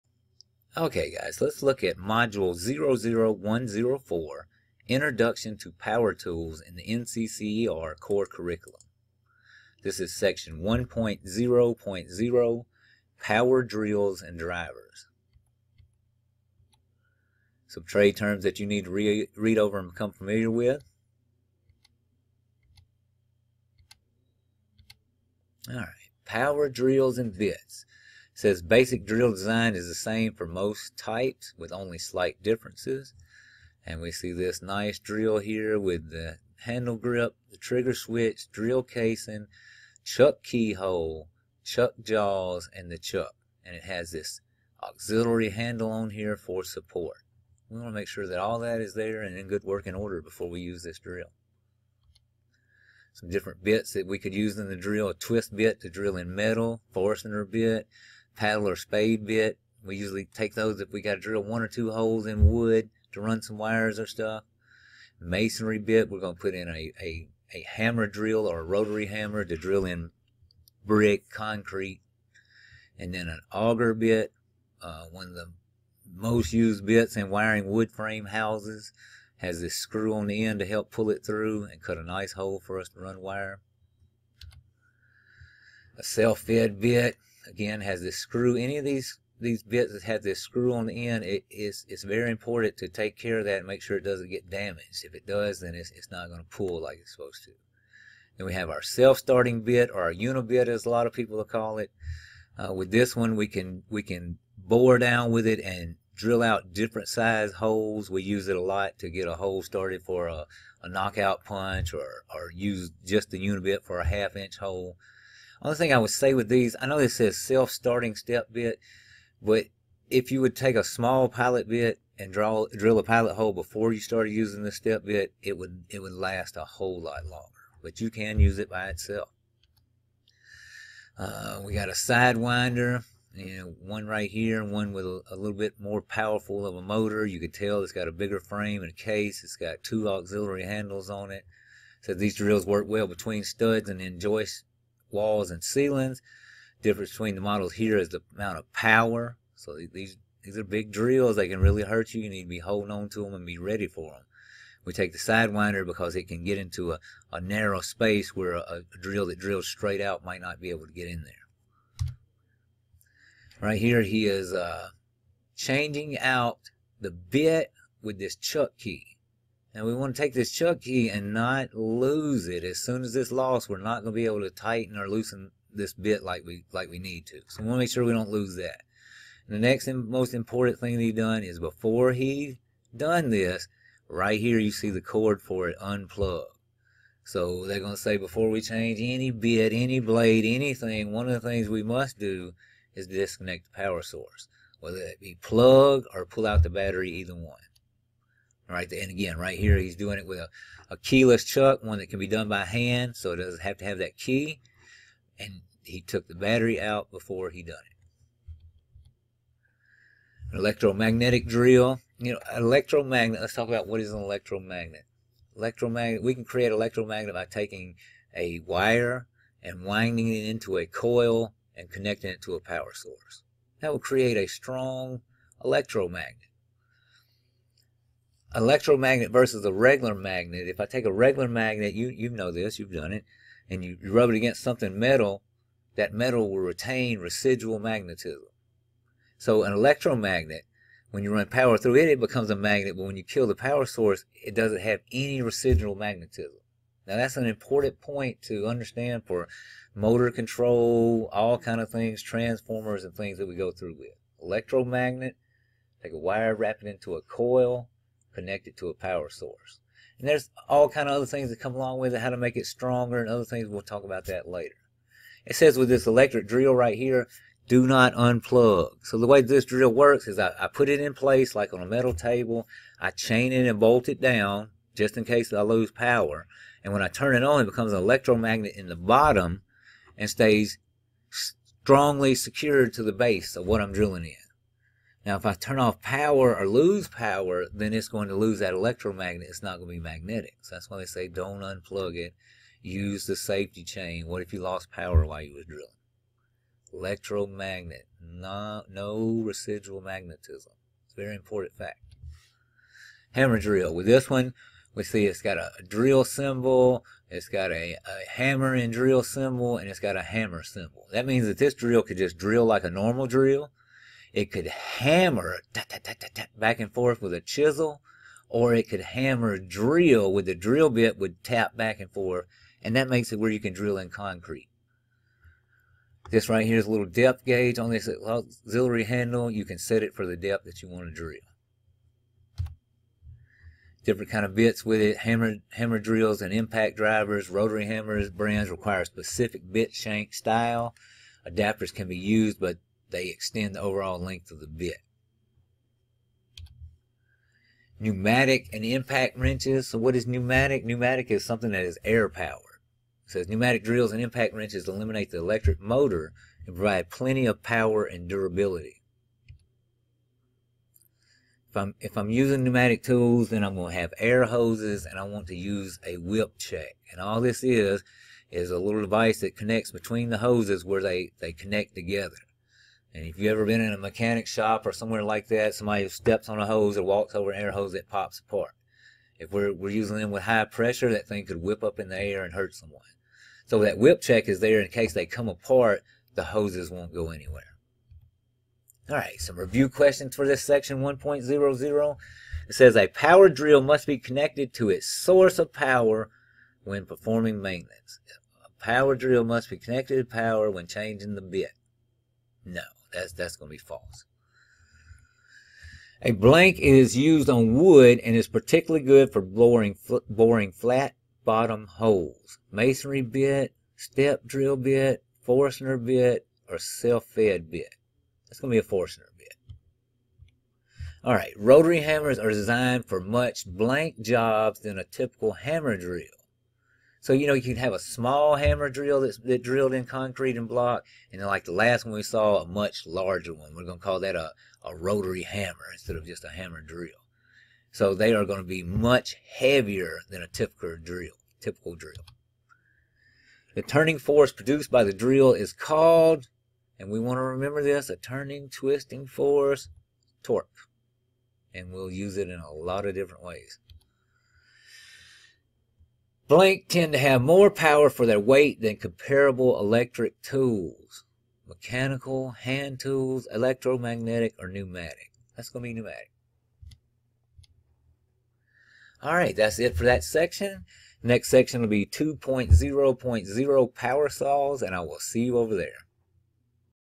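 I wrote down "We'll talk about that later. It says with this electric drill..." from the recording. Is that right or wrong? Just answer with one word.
right.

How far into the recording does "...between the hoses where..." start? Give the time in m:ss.
6:09.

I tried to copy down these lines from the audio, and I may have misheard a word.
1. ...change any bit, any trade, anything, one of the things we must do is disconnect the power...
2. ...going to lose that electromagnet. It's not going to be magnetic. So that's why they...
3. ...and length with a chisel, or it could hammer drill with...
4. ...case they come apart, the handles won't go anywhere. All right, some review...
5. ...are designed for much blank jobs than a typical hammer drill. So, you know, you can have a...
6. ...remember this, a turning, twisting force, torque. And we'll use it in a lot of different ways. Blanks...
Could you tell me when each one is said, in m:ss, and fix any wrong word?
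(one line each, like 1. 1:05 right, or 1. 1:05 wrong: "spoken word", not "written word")
1. 3:08 wrong: "blade", not "trade"
2. 4:48 right
3. 5:16 wrong: "forth", not "length"
4. 6:24 wrong: "hoses", not "handles"
5. 7:02 right
6. 7:27 right.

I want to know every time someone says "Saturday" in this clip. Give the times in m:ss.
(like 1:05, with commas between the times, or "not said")
not said.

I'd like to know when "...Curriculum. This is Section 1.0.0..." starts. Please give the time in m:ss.
0:08.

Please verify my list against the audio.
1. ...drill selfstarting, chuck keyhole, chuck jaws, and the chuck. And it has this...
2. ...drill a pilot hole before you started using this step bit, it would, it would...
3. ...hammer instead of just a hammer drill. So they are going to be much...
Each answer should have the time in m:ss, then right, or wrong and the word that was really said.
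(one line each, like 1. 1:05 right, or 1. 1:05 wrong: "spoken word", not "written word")
1. 0:38 wrong: "casing", not "selfstarting"
2. 2:02 right
3. 7:15 right.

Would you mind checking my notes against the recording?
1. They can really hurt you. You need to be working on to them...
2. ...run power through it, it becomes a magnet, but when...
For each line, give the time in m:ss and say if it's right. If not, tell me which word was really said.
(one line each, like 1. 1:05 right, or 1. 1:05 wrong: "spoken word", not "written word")
1. 2:31 wrong: "holding", not "working"
2. 4:01 right.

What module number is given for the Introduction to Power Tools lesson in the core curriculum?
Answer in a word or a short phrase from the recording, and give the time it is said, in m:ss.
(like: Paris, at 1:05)
00104, at 0:01.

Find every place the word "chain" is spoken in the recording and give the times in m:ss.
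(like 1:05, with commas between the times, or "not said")
4:33, 4:53.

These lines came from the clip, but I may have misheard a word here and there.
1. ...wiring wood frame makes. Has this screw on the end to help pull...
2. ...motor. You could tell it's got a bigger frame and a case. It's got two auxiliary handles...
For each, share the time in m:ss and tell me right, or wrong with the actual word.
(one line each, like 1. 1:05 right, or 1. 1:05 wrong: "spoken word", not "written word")
1. 1:17 wrong: "houses", not "makes"
2. 2:16 right.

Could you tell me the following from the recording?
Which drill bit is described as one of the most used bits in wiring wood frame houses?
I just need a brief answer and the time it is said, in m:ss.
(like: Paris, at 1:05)
Auger bit, at 1:13.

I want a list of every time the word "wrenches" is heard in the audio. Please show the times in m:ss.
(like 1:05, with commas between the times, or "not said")
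5:49, 5:54.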